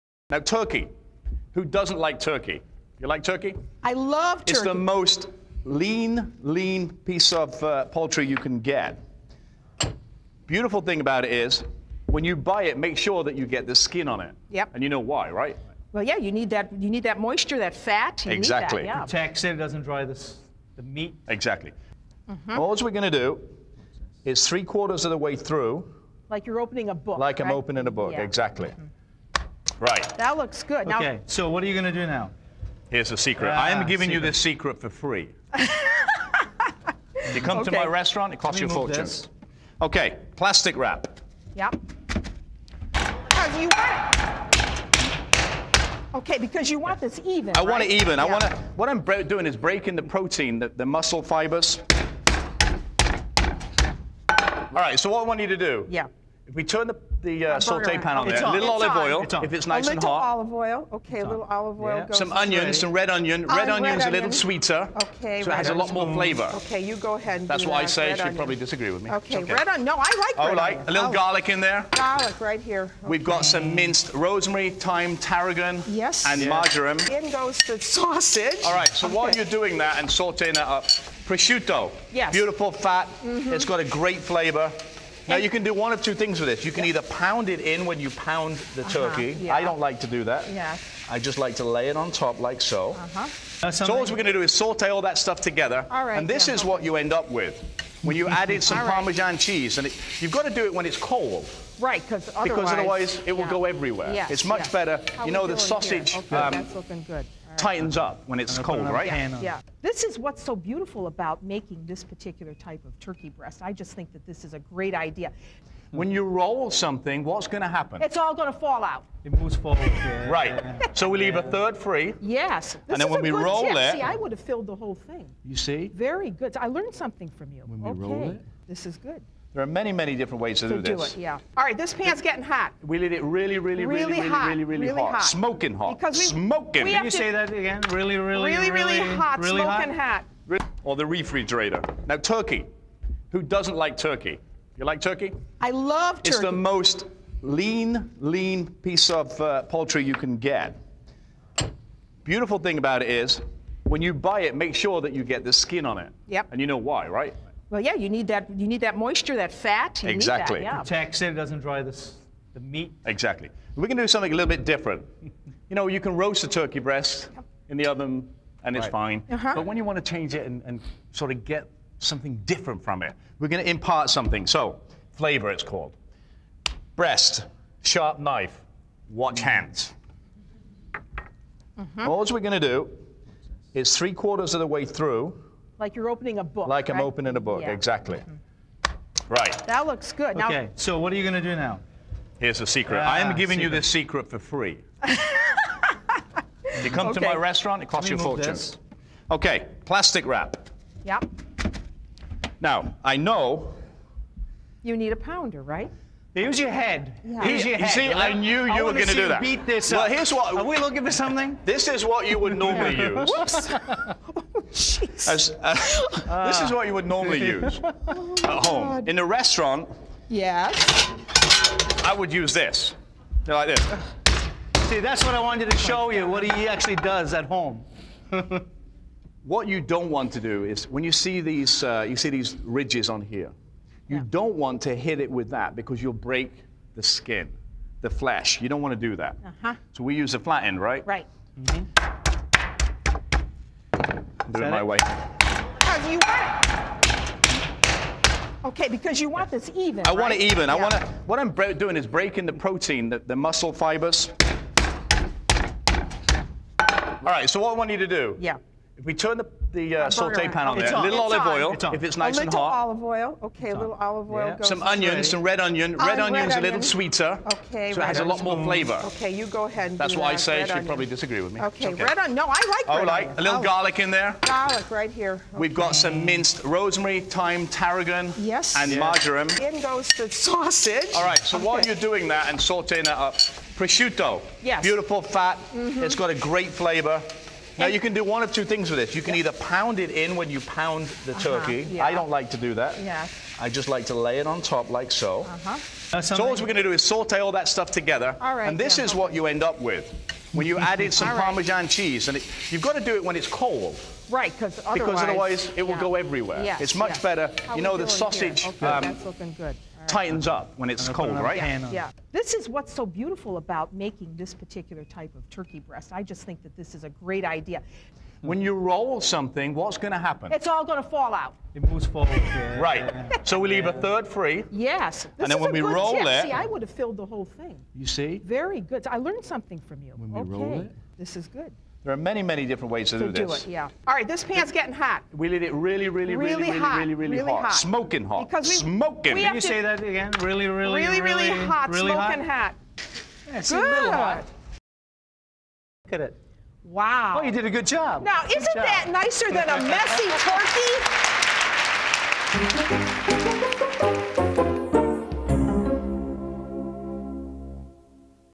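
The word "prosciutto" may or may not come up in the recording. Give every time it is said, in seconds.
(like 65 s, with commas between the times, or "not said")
81 s, 283 s.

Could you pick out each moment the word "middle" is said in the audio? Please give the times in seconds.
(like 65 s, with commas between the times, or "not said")
not said.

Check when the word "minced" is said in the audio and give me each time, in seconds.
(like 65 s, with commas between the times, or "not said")
73 s, 276 s.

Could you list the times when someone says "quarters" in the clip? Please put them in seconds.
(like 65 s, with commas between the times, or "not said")
24 s, 184 s.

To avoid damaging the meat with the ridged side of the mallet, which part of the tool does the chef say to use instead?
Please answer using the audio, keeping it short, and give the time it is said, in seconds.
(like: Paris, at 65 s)
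flat end, at 240 s.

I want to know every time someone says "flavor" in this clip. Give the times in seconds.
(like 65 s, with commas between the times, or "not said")
66 s, 84 s, 175 s, 268 s, 286 s.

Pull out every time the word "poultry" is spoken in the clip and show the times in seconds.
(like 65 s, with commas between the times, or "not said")
7 s, 149 s.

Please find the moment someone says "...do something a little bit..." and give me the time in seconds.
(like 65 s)
163 s.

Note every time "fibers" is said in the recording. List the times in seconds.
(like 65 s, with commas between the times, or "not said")
51 s, 253 s.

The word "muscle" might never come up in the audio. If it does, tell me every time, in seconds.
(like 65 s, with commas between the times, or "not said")
50 s, 253 s.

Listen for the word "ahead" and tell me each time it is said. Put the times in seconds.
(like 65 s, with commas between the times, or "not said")
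67 s, 269 s.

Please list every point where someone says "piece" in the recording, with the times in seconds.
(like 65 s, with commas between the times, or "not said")
7 s, 148 s.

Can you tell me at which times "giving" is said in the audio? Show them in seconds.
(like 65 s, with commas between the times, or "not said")
33 s, 193 s.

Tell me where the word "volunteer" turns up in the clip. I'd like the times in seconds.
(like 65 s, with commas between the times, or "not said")
not said.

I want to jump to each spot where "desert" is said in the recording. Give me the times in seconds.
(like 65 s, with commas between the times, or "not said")
not said.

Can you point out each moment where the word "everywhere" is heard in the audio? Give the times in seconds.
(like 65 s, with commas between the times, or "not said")
103 s, 306 s.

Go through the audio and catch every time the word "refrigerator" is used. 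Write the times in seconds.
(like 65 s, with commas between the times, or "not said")
141 s.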